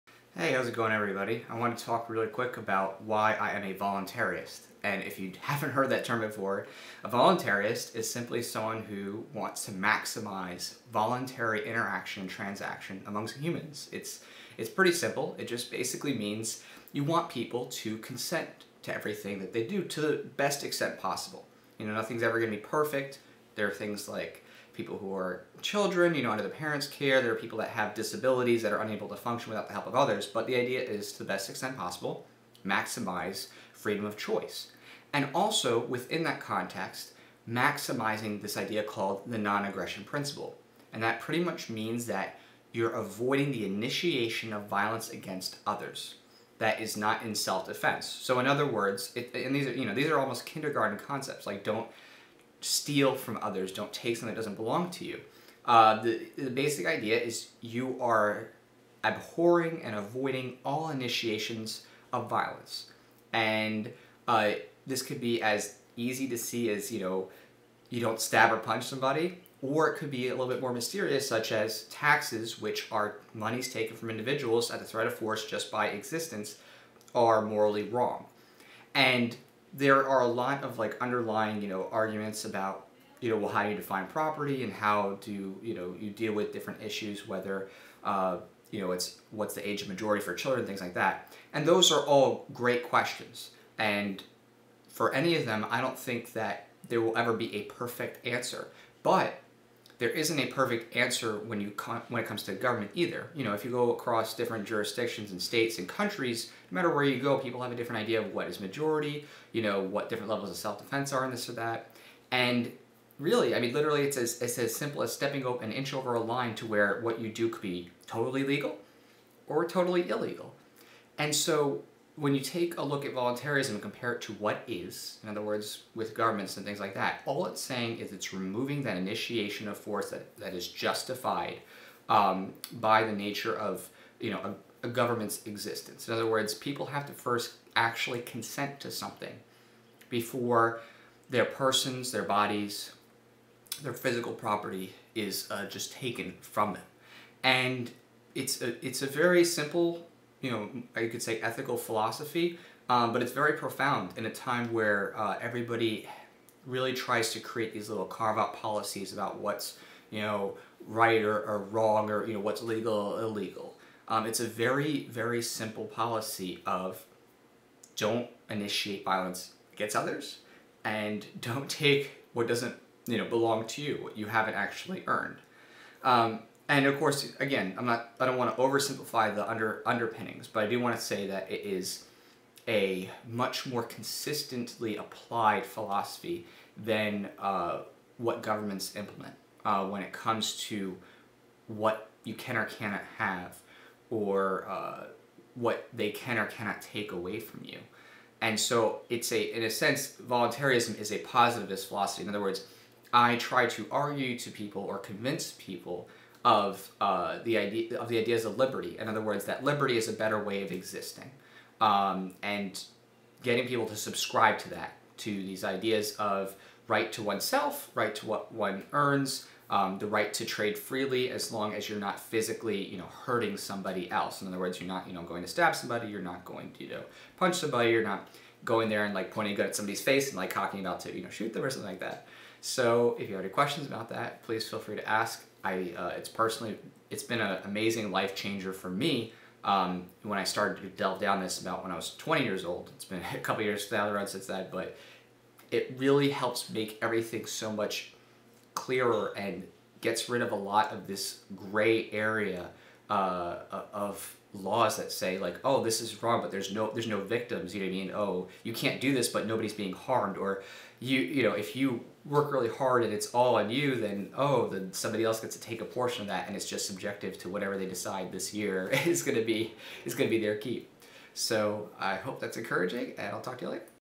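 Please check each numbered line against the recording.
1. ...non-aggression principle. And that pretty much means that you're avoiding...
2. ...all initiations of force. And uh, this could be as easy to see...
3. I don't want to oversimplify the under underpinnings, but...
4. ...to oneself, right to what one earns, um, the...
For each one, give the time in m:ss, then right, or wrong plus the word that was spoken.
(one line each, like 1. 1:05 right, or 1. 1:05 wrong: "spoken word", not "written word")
1. 0:39 right
2. 1:00 wrong: "violence", not "force"
3. 2:58 right
4. 3:37 right.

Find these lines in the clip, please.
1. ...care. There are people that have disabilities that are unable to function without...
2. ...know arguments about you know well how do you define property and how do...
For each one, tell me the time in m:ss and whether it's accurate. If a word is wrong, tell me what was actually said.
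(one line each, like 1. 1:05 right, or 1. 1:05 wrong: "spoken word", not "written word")
1. 0:26 right
2. 1:21 right.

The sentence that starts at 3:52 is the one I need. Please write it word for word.
So if you have any questions about that, please feel free to ask.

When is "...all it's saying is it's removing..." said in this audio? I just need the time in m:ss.
2:07.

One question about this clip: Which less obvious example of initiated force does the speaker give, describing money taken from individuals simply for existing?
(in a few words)
taxes.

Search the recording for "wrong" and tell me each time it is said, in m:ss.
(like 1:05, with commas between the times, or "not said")
1:17, 2:41, 4:16.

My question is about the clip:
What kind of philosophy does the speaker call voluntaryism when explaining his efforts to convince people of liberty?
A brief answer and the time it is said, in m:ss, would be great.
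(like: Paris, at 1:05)
positivist, at 3:21.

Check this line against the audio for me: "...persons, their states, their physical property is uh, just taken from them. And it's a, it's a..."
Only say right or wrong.
wrong.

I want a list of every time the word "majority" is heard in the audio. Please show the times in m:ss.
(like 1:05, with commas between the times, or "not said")
1:29, 1:48.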